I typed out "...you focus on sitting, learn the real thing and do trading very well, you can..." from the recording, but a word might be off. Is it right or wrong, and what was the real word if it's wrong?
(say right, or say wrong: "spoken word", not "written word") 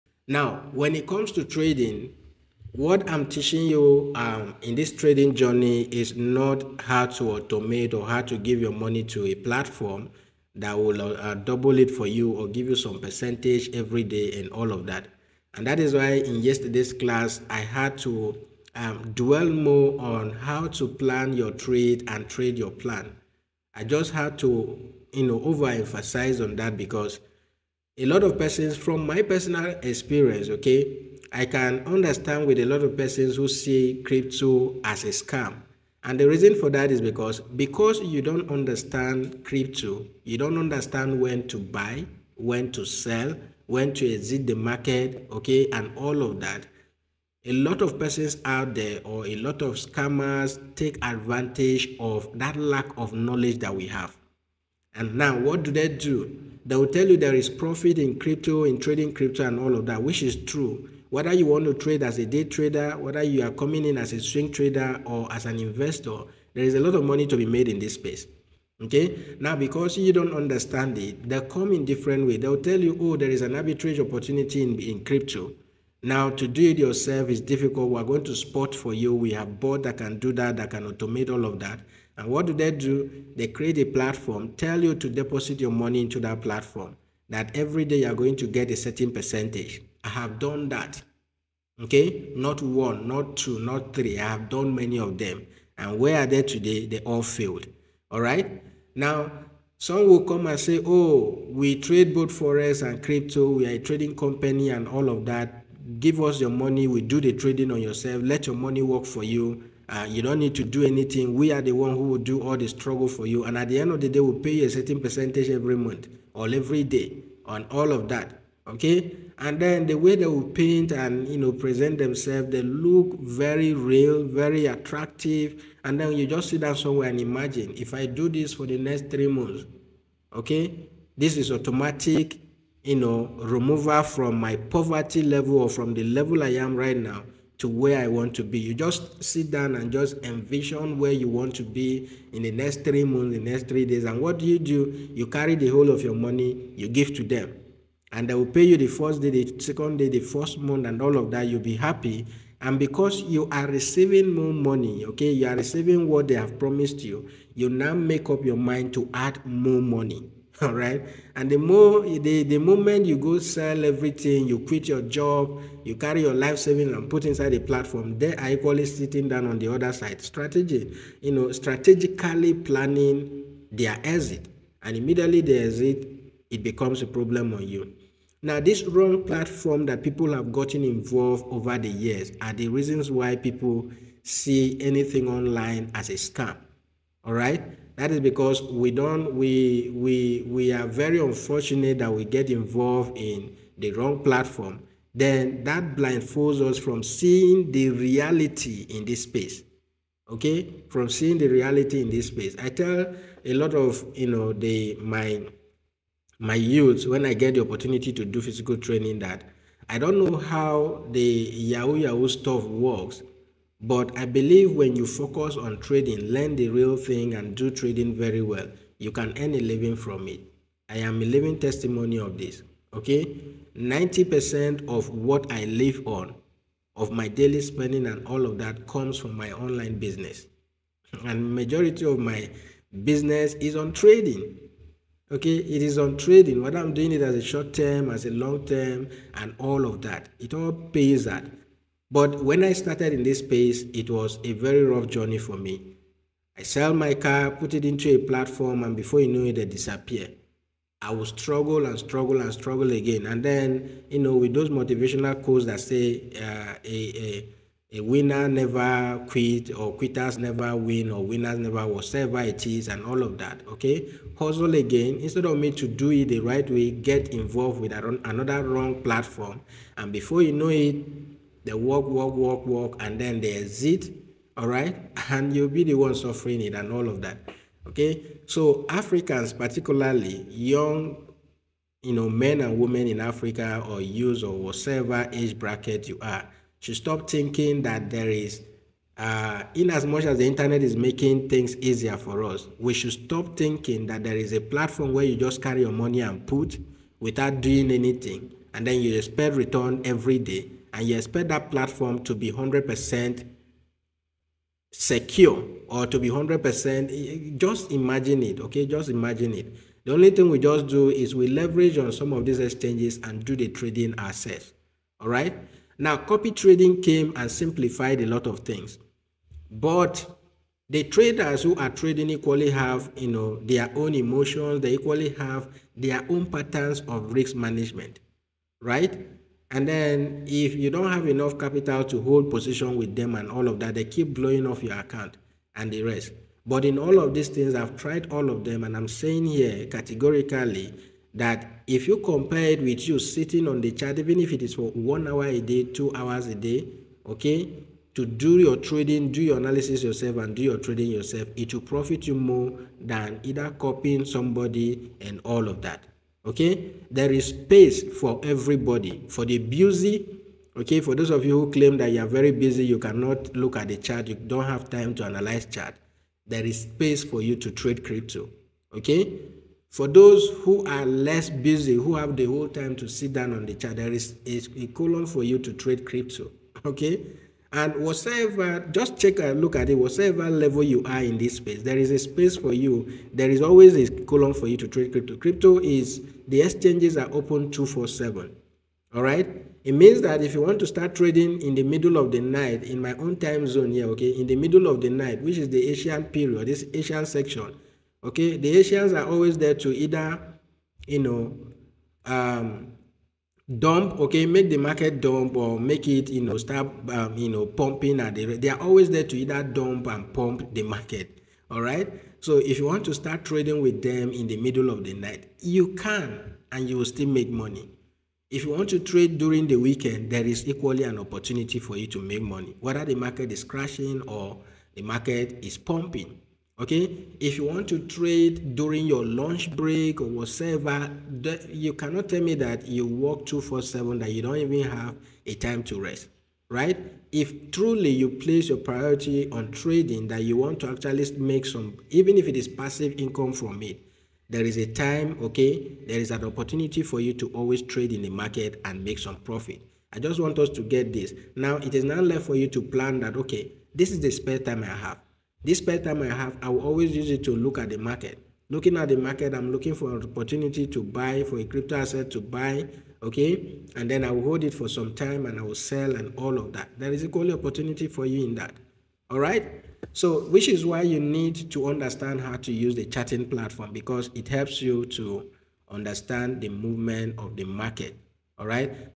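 wrong: "trading", not "sitting".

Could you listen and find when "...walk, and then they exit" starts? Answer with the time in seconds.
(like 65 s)
272 s.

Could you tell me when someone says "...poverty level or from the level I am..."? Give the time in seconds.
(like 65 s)
134 s.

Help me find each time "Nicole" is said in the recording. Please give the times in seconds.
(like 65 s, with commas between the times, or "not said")
not said.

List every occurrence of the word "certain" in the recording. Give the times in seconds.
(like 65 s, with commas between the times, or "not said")
88 s, 114 s.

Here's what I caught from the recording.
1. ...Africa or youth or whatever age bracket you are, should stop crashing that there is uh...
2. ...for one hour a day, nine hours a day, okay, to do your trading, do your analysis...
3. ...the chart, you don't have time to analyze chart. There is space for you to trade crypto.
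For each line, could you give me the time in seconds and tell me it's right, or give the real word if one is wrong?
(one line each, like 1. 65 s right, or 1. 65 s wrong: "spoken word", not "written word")
1. 283 s wrong: "thinking", not "crashing"
2. 344 s wrong: "two", not "nine"
3. 363 s right.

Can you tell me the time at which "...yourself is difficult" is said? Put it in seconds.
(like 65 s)
76 s.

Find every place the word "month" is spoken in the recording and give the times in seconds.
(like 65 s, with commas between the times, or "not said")
115 s, 129 s, 143 s, 150 s.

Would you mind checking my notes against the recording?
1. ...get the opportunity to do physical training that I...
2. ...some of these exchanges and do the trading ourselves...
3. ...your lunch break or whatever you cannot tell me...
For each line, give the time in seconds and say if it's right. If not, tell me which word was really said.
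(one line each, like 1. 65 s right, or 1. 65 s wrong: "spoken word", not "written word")
1. 207 s right
2. 312 s right
3. 429 s right.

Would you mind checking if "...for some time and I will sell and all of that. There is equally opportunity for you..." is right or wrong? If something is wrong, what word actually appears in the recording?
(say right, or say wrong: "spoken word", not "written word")
right.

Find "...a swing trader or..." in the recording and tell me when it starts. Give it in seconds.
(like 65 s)
64 s.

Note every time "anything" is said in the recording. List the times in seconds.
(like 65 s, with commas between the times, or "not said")
110 s, 184 s, 297 s.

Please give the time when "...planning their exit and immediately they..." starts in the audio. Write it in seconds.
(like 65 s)
172 s.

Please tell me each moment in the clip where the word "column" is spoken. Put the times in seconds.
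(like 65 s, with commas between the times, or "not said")
384 s.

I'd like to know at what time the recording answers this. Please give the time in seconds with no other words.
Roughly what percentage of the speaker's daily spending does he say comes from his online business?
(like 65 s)
223 s.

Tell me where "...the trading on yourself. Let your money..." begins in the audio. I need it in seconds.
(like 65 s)
107 s.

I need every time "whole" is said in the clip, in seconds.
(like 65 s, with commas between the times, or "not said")
145 s, 372 s.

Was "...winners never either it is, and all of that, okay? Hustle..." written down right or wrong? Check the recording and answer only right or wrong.
wrong.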